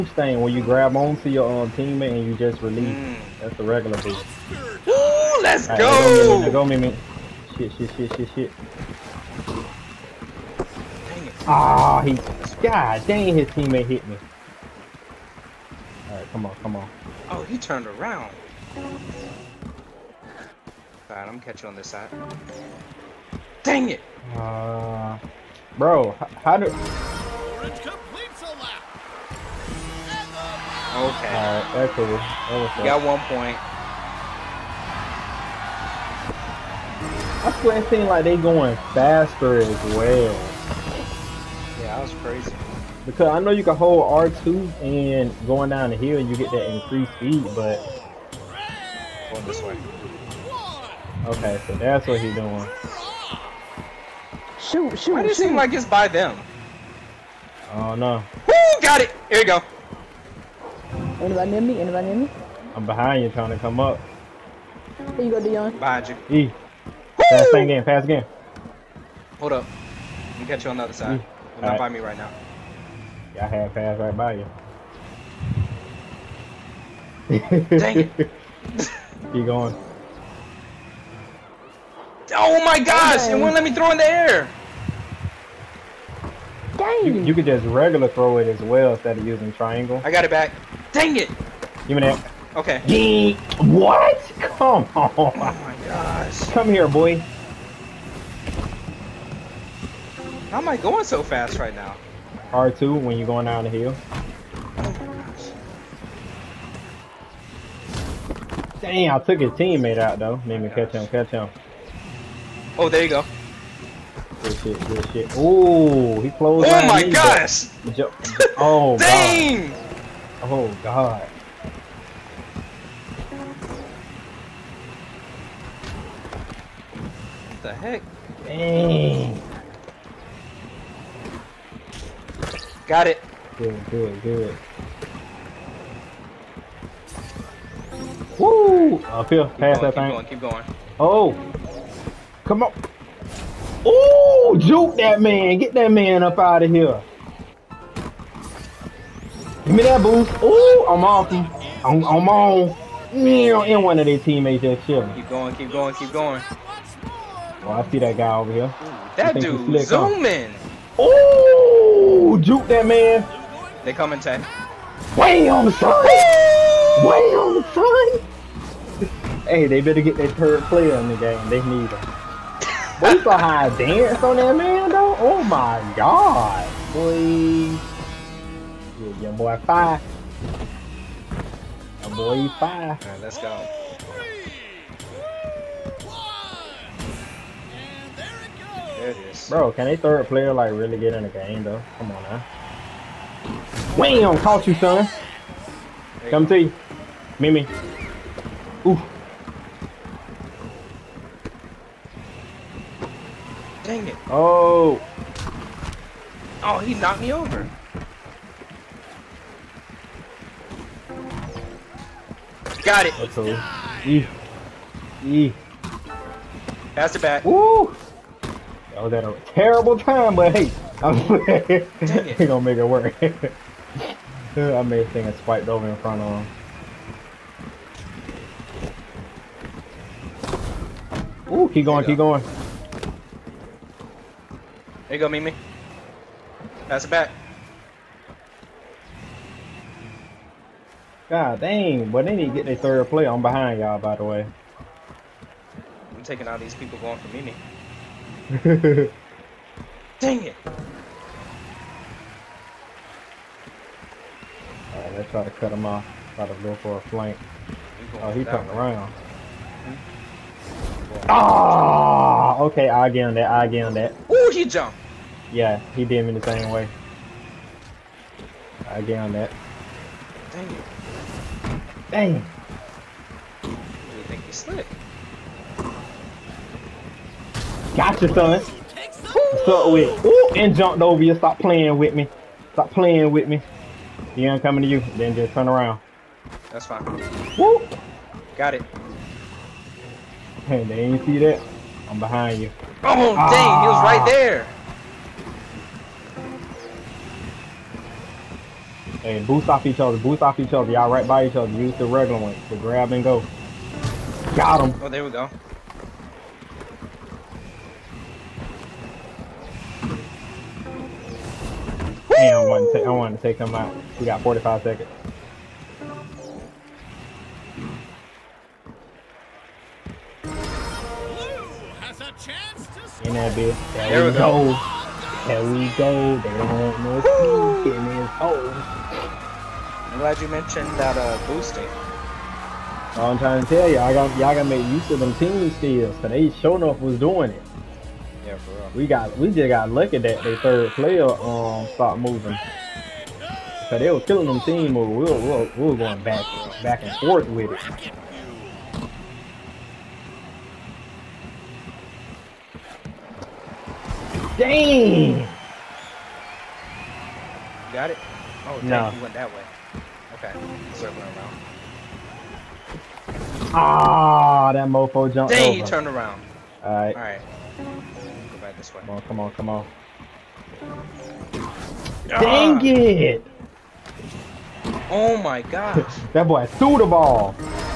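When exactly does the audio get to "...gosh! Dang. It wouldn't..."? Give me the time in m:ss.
1:22.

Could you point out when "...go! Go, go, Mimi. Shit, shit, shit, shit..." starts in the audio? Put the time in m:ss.
0:05.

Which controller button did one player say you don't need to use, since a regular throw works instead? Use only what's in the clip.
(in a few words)
Triangle.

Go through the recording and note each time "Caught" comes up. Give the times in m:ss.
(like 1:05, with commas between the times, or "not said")
3:14.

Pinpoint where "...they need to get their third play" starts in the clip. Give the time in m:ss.
4:02.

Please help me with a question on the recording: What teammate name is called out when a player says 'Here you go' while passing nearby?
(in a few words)
Dion.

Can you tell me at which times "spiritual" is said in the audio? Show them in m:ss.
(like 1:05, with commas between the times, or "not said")
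not said.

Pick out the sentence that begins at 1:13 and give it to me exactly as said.
Y'all had passed right by you.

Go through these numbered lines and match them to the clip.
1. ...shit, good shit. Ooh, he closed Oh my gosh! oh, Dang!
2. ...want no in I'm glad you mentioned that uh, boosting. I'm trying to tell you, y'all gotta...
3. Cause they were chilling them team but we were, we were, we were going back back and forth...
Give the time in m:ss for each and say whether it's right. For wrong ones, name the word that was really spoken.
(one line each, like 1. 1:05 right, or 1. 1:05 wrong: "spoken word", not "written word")
1. 1:54 right
2. 5:26 right
3. 5:43 wrong: "killing", not "chilling".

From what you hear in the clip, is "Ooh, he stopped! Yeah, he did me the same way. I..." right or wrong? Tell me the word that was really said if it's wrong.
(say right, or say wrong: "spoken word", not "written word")
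wrong: "jumped", not "stopped".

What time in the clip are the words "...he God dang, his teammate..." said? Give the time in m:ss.
0:12.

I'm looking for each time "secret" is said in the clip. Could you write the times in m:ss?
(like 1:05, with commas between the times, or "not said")
not said.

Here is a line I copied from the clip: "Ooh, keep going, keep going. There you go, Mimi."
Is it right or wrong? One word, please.
right.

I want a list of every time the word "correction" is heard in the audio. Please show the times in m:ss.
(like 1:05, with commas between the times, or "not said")
not said.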